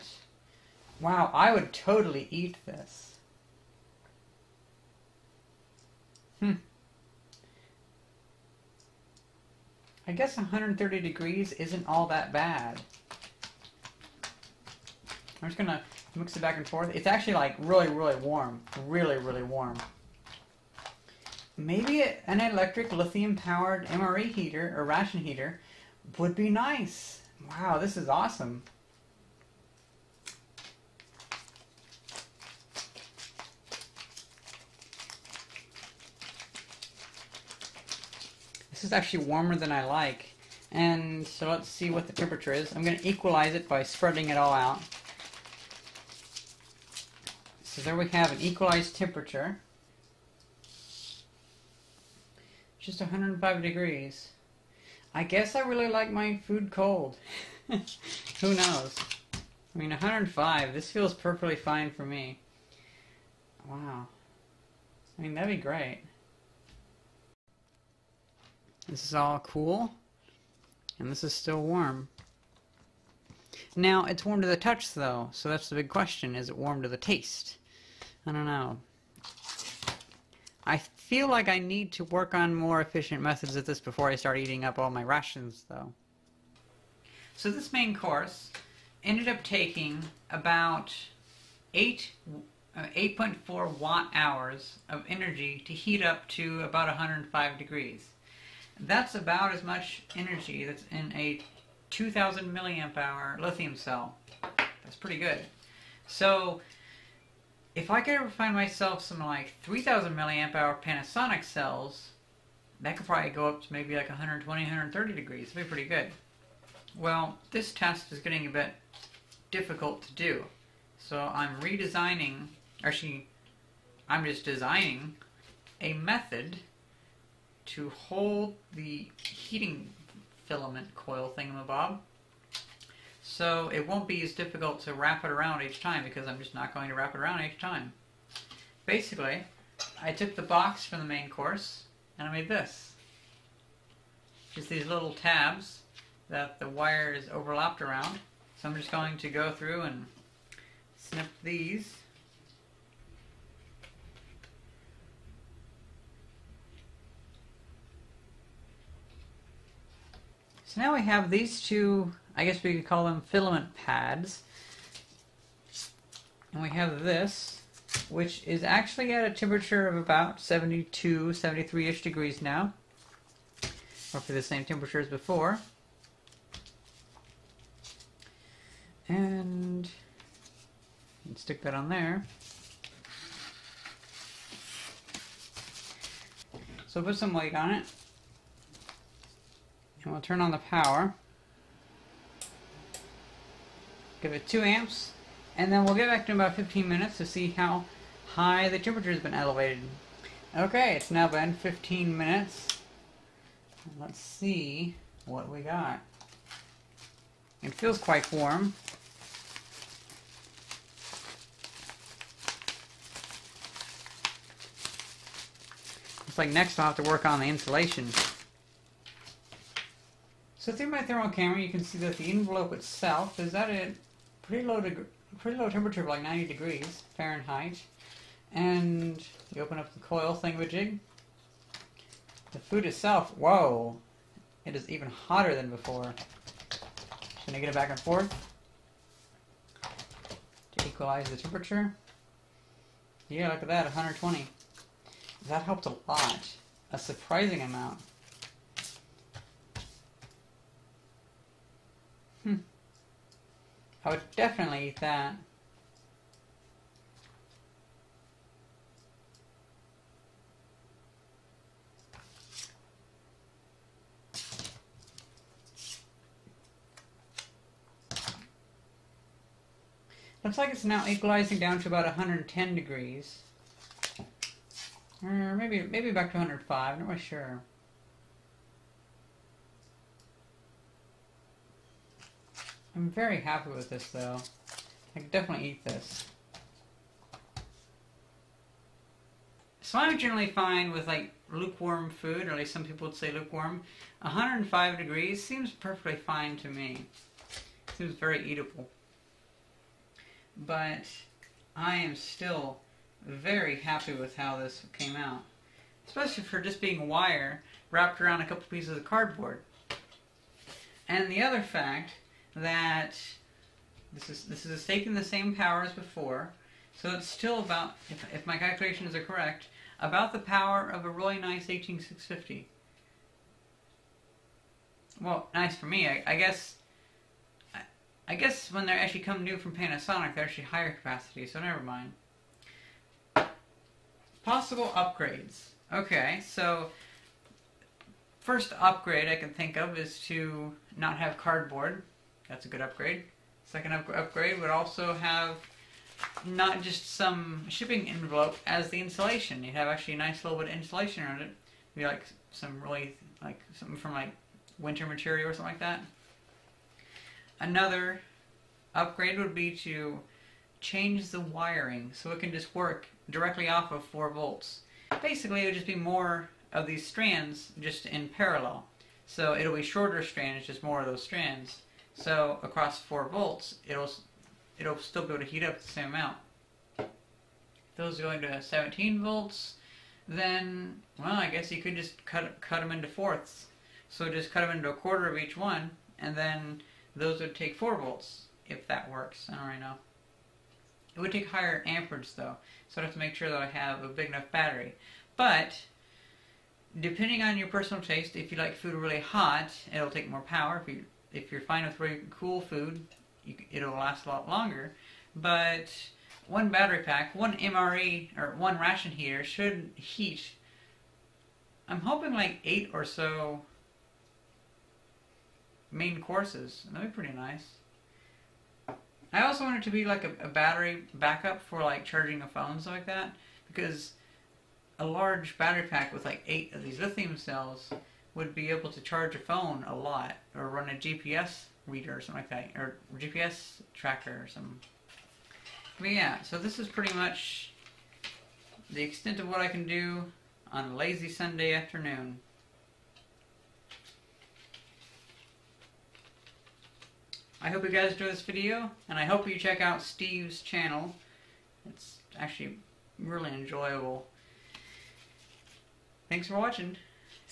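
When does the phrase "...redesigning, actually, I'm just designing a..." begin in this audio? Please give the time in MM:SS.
02:01.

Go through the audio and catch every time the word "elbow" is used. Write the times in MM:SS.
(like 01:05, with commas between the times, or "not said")
not said.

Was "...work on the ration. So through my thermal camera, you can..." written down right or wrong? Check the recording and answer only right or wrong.
wrong.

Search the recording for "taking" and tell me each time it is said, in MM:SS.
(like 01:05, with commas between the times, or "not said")
01:29, 05:14.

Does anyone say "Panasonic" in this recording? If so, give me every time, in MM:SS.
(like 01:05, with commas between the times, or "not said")
01:50, 05:29.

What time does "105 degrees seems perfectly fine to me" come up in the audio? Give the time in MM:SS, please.
04:54.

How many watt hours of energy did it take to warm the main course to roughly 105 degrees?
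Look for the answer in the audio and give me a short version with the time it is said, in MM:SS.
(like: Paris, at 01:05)
8.4, at 01:32.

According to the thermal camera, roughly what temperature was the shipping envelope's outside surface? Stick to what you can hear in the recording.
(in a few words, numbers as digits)
90 degrees Fahrenheit.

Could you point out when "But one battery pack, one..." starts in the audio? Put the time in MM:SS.
06:45.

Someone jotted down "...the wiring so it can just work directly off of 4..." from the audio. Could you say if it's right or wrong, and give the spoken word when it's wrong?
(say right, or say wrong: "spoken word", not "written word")
right.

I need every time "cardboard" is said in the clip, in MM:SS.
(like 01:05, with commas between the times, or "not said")
05:09, 05:41.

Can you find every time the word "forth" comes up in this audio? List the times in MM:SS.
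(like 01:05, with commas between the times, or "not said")
00:16, 03:57.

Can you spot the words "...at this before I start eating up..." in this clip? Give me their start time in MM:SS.
01:23.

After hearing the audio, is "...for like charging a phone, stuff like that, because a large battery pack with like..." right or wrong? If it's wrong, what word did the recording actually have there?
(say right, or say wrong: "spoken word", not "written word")
right.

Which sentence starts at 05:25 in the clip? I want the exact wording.
Well, nice for me, I, I guess.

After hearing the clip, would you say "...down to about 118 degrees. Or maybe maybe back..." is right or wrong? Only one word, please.
wrong.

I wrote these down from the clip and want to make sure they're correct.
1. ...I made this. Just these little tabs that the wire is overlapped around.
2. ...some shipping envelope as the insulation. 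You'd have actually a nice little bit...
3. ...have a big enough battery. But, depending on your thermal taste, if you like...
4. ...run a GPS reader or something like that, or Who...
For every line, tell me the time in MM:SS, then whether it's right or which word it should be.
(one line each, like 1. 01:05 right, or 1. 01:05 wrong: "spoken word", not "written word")
1. 02:22 right
2. 05:47 right
3. 06:33 wrong: "personal", not "thermal"
4. 07:10 wrong: "GPS", not "Who".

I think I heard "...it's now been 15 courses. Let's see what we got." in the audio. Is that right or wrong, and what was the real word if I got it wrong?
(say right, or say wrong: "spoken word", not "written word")
wrong: "minutes", not "courses".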